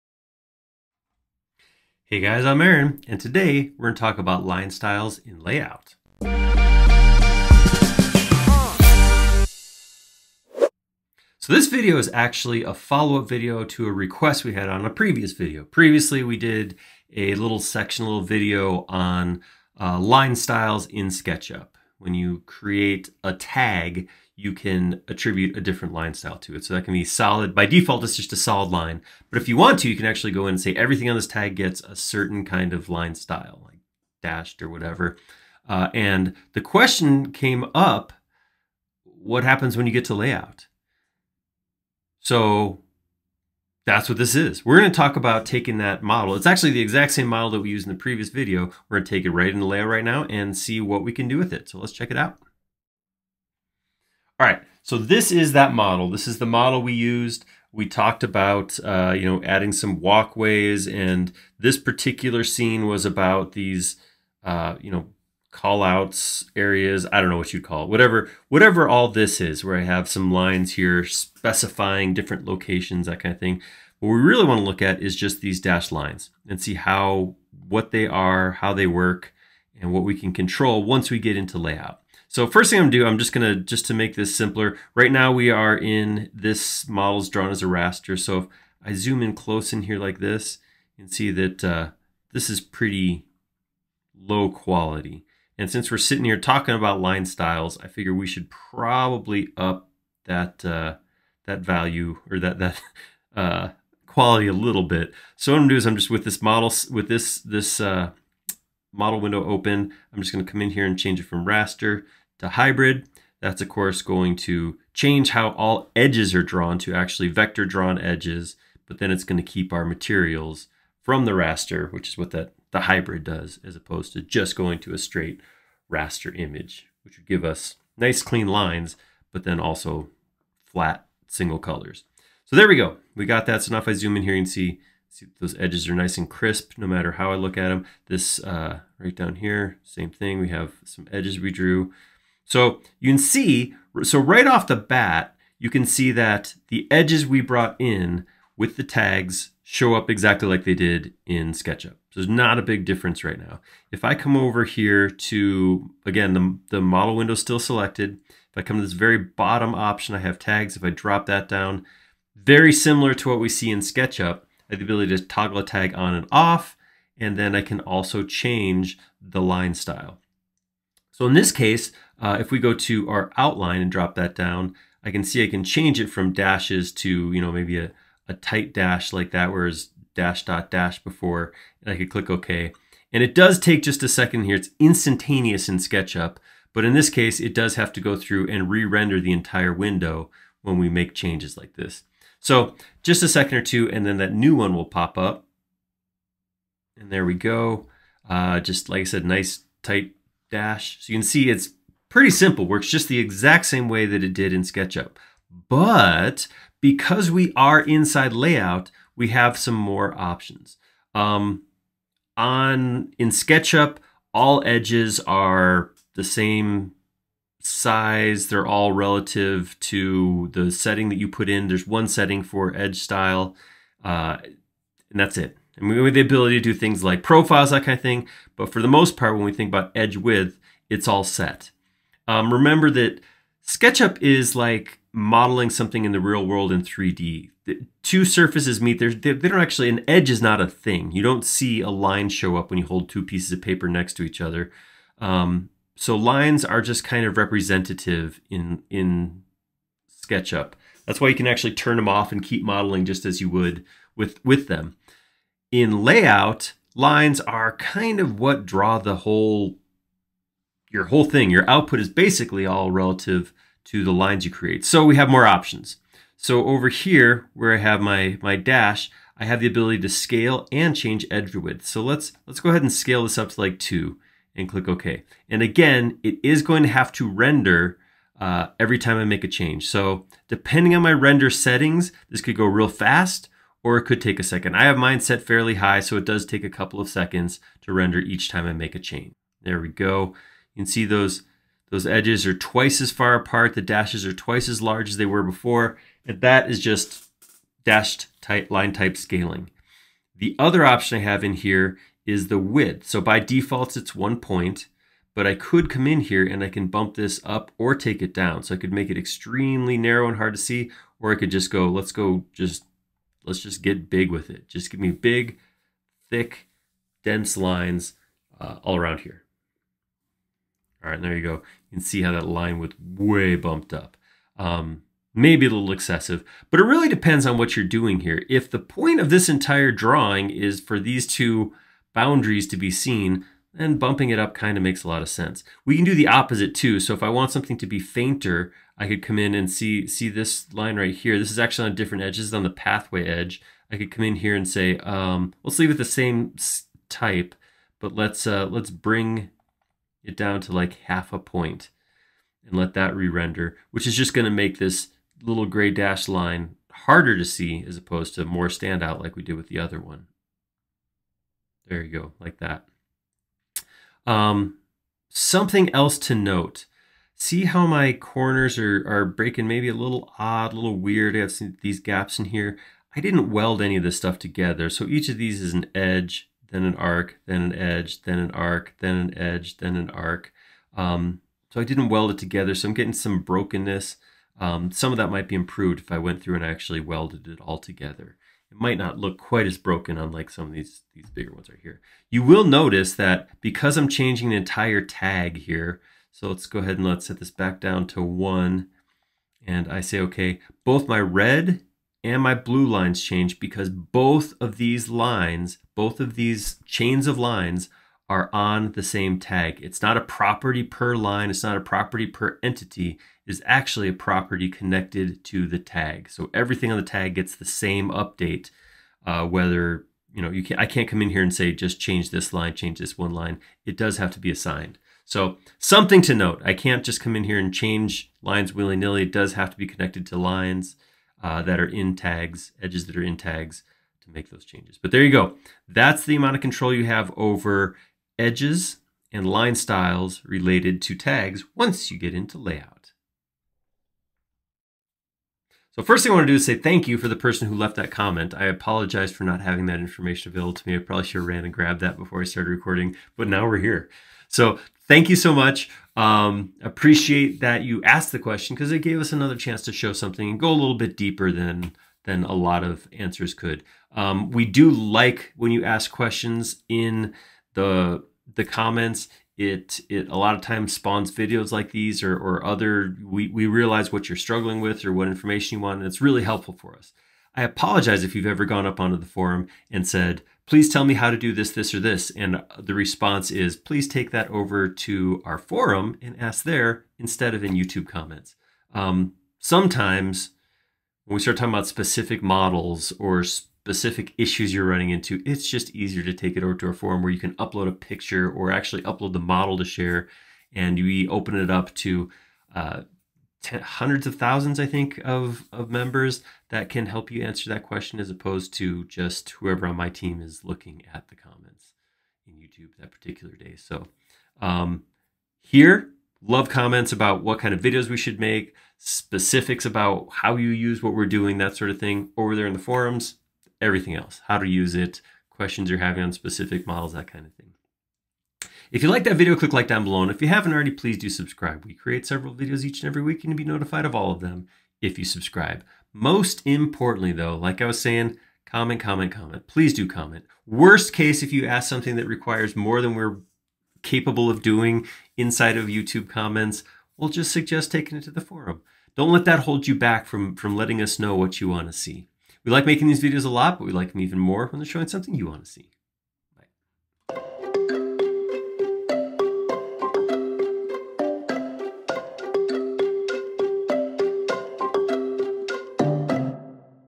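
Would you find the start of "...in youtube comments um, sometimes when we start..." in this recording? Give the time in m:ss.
8:07.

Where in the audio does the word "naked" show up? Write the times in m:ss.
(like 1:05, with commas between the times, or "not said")
not said.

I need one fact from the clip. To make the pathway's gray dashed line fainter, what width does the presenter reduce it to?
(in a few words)
half a point.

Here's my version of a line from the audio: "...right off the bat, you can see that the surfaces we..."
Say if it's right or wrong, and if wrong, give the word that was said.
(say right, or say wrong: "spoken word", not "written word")
wrong: "edges", not "surfaces".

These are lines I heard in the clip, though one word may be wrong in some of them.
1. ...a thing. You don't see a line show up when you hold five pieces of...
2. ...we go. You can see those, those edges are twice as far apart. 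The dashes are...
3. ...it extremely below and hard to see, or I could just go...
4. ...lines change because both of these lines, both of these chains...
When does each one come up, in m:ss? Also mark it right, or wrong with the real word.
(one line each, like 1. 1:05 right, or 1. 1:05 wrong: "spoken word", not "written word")
1. 4:00 wrong: "two", not "five"
2. 4:49 right
3. 5:09 wrong: "narrow", not "below"
4. 6:42 right.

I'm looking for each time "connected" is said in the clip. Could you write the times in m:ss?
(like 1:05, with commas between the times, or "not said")
6:54, 7:09.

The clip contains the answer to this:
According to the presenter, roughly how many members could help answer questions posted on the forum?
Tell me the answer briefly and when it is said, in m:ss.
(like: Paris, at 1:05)
hundreds of thousands, at 8:23.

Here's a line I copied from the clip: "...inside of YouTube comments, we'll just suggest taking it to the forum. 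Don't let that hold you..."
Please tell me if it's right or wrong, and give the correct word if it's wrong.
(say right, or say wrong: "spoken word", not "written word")
right.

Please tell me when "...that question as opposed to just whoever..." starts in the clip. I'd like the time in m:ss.
8:27.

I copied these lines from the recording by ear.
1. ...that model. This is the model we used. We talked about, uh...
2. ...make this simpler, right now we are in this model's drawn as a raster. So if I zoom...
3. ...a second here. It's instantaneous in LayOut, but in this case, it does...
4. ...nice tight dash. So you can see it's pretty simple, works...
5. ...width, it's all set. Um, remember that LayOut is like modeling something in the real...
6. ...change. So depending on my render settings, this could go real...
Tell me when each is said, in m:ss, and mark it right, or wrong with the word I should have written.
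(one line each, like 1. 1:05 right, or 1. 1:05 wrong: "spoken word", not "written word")
1. 0:55 right
2. 1:23 right
3. 3:04 wrong: "SketchUp", not "LayOut"
4. 3:19 right
5. 3:50 wrong: "SketchUp", not "LayOut"
6. 4:39 right.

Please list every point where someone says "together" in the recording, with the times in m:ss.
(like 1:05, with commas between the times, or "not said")
6:14, 6:22, 6:27.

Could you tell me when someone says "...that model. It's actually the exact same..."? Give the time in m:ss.
0:45.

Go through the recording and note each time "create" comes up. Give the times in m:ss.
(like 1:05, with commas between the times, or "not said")
0:22, 4:24, 8:51.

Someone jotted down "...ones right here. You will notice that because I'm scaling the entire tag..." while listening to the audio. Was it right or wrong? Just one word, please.
wrong.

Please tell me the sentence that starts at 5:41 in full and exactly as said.
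This is actually on different edges, on the pathway edge.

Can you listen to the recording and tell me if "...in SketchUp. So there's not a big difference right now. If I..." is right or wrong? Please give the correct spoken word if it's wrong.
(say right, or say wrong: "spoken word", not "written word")
right.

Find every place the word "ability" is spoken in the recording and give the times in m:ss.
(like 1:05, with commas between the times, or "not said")
2:44, 3:46, 4:29.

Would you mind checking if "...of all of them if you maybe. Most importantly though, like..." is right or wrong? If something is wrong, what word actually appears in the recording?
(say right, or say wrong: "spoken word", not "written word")
wrong: "subscribe", not "maybe".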